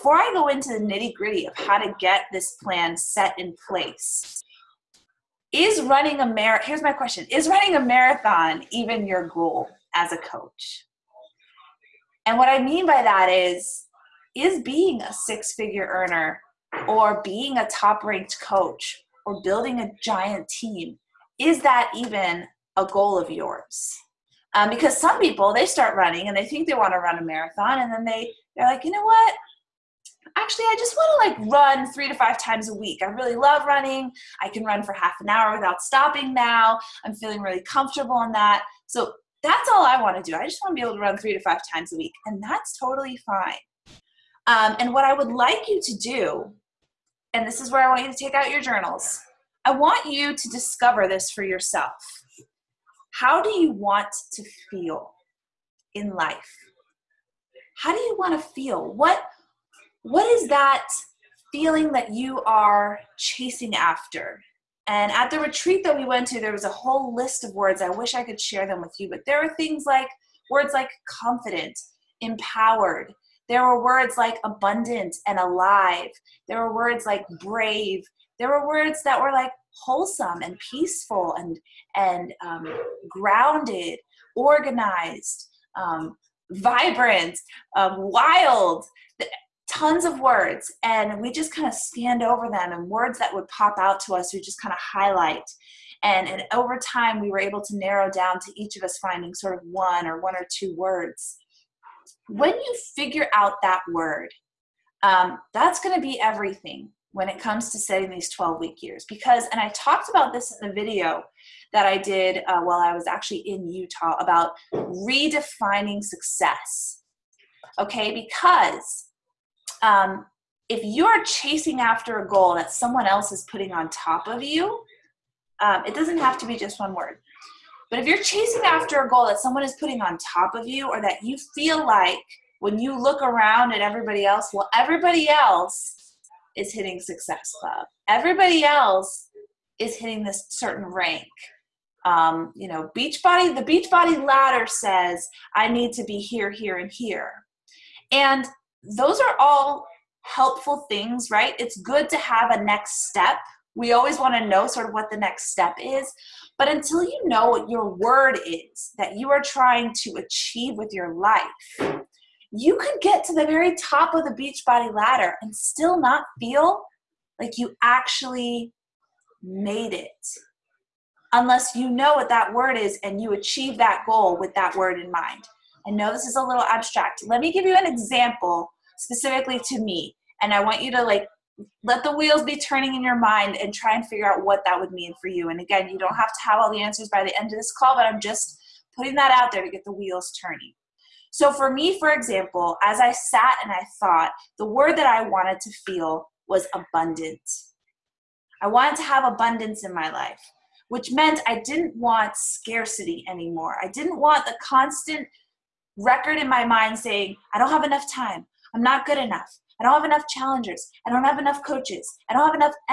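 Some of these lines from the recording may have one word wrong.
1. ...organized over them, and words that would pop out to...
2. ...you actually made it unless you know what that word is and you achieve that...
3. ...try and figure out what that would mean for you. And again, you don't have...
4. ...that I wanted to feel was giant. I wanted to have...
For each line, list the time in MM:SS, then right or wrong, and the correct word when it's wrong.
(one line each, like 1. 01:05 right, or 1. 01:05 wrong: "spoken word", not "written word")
1. 01:31 wrong: "scanned", not "organized"
2. 02:47 right
3. 03:03 right
4. 03:14 wrong: "abundant", not "giant".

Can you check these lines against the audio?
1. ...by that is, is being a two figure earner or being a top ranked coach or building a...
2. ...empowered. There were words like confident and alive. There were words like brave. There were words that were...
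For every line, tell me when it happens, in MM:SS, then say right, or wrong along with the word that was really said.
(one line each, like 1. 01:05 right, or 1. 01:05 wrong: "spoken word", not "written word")
1. 00:12 wrong: "six", not "two"
2. 01:12 wrong: "abundant", not "confident".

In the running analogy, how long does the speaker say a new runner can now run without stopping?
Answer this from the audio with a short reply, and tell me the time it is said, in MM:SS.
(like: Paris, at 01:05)
half an hour, at 00:34.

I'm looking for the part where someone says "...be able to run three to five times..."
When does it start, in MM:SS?
00:40.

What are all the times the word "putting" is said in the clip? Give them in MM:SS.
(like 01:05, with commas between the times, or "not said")
02:03, 02:09, 03:08.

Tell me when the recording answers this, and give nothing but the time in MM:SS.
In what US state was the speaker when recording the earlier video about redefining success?
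01:53.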